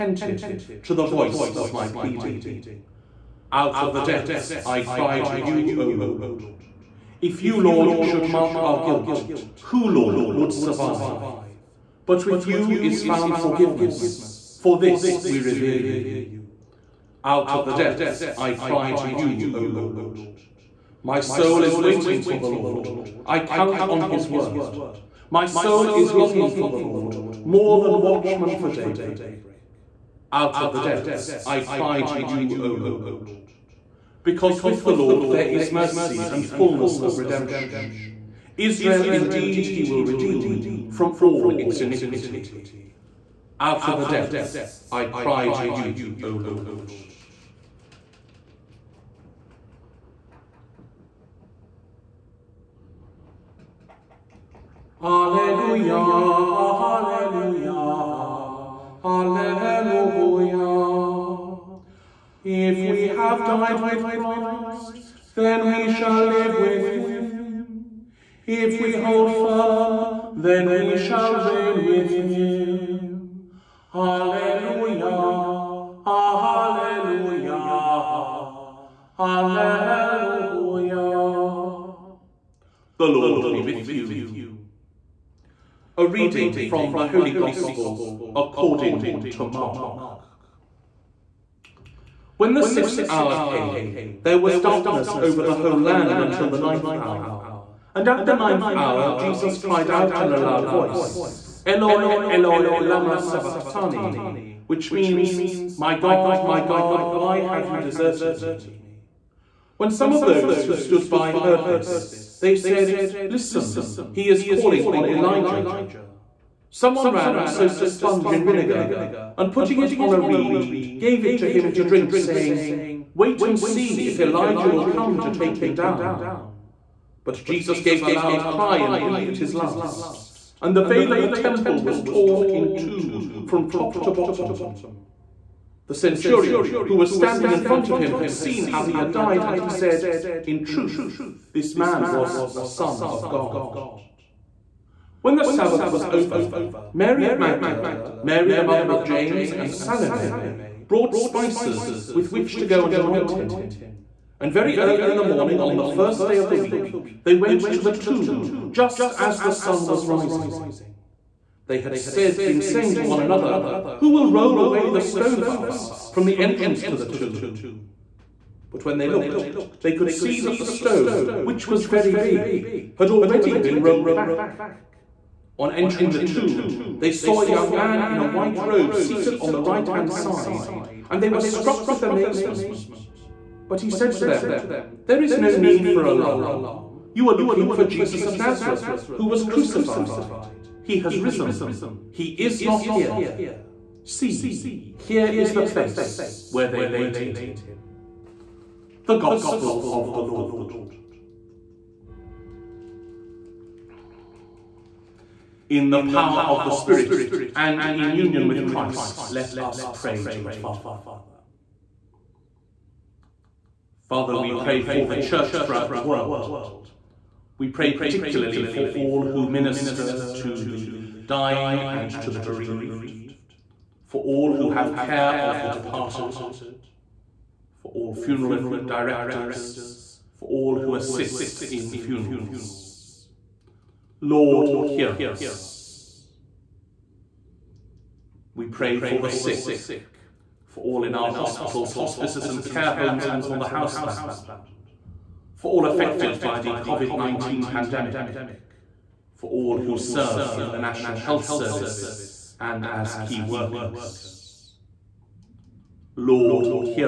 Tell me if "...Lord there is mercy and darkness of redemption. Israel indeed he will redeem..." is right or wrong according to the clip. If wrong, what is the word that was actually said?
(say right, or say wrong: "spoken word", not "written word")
wrong: "fullness", not "darkness".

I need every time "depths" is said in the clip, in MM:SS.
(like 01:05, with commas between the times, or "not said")
00:04, 00:17, 00:30, 00:44.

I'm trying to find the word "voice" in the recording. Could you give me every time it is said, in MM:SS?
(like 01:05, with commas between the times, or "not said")
00:01, 01:40.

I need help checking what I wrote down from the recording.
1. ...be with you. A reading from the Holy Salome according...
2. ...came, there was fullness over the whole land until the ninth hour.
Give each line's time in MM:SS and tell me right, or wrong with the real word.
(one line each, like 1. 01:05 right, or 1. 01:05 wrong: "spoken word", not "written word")
1. 01:23 wrong: "Gospel", not "Salome"
2. 01:33 wrong: "darkness", not "fullness".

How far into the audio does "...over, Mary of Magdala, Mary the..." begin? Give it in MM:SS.
02:26.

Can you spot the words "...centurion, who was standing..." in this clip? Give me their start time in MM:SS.
02:15.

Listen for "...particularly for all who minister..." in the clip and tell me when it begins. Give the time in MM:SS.
03:37.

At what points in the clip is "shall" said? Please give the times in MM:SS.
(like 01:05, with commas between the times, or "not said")
01:05, 01:10.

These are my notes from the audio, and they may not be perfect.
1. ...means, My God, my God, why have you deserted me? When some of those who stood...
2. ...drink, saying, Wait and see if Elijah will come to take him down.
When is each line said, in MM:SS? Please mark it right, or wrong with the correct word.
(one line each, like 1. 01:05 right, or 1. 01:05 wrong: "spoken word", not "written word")
1. 01:44 right
2. 02:01 right.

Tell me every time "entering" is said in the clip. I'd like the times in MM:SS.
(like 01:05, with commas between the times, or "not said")
02:55.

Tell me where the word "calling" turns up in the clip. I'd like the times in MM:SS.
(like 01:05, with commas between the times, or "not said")
01:54.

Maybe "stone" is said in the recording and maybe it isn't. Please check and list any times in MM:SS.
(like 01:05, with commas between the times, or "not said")
02:45, 02:50.